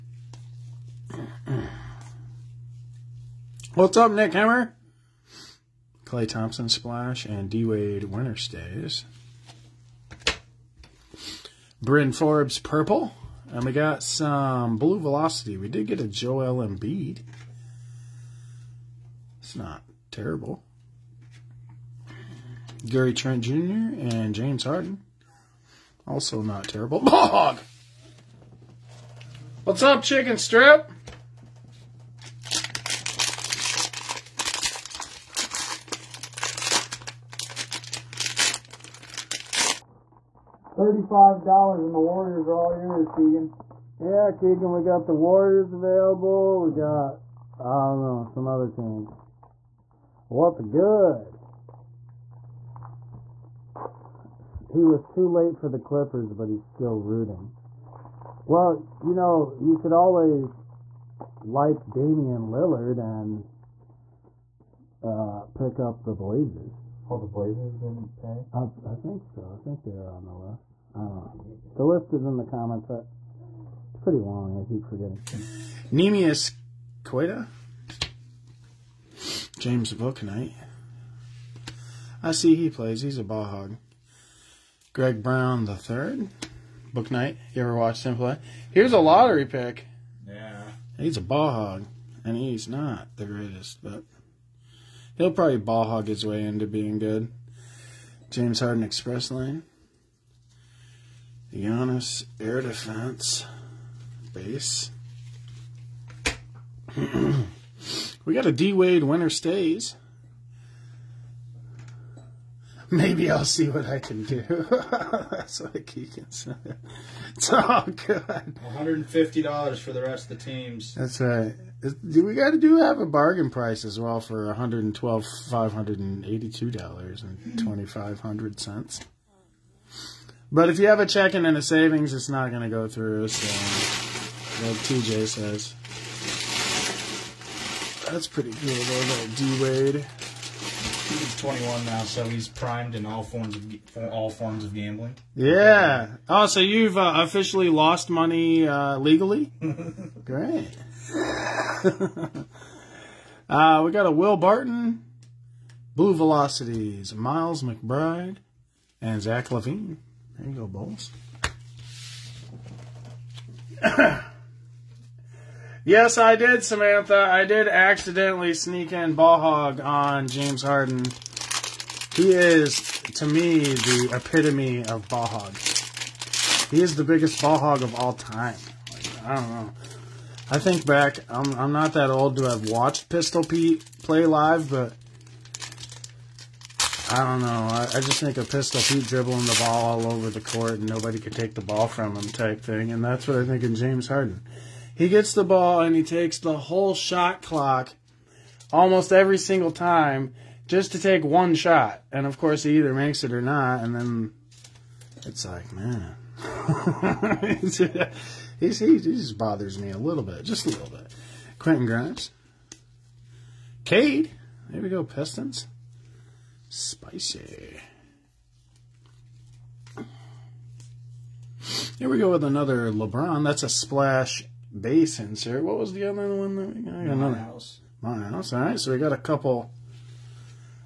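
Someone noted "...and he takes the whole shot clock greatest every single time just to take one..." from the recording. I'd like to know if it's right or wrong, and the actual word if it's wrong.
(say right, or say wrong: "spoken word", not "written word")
wrong: "almost", not "greatest".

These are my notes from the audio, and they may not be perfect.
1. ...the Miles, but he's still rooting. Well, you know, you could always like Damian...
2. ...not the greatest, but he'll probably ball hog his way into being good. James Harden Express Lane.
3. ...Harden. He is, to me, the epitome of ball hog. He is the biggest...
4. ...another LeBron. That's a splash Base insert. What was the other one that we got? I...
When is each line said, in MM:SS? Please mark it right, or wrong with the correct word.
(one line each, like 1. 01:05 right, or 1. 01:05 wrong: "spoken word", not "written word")
1. 00:55 wrong: "Clippers", not "Miles"
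2. 01:32 right
3. 02:50 right
4. 03:42 right.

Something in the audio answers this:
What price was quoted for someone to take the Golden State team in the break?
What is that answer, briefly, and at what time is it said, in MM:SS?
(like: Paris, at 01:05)
$35, at 00:40.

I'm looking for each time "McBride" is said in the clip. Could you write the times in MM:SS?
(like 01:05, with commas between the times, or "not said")
02:37.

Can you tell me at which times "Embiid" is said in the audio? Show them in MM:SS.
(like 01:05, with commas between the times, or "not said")
00:16.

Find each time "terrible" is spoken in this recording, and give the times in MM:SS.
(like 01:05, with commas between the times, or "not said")
00:20, 00:26.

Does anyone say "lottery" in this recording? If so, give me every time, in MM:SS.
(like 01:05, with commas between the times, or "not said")
01:28.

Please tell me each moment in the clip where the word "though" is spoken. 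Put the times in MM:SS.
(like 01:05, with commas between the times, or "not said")
02:18.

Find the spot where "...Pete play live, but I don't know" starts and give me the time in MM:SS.
03:03.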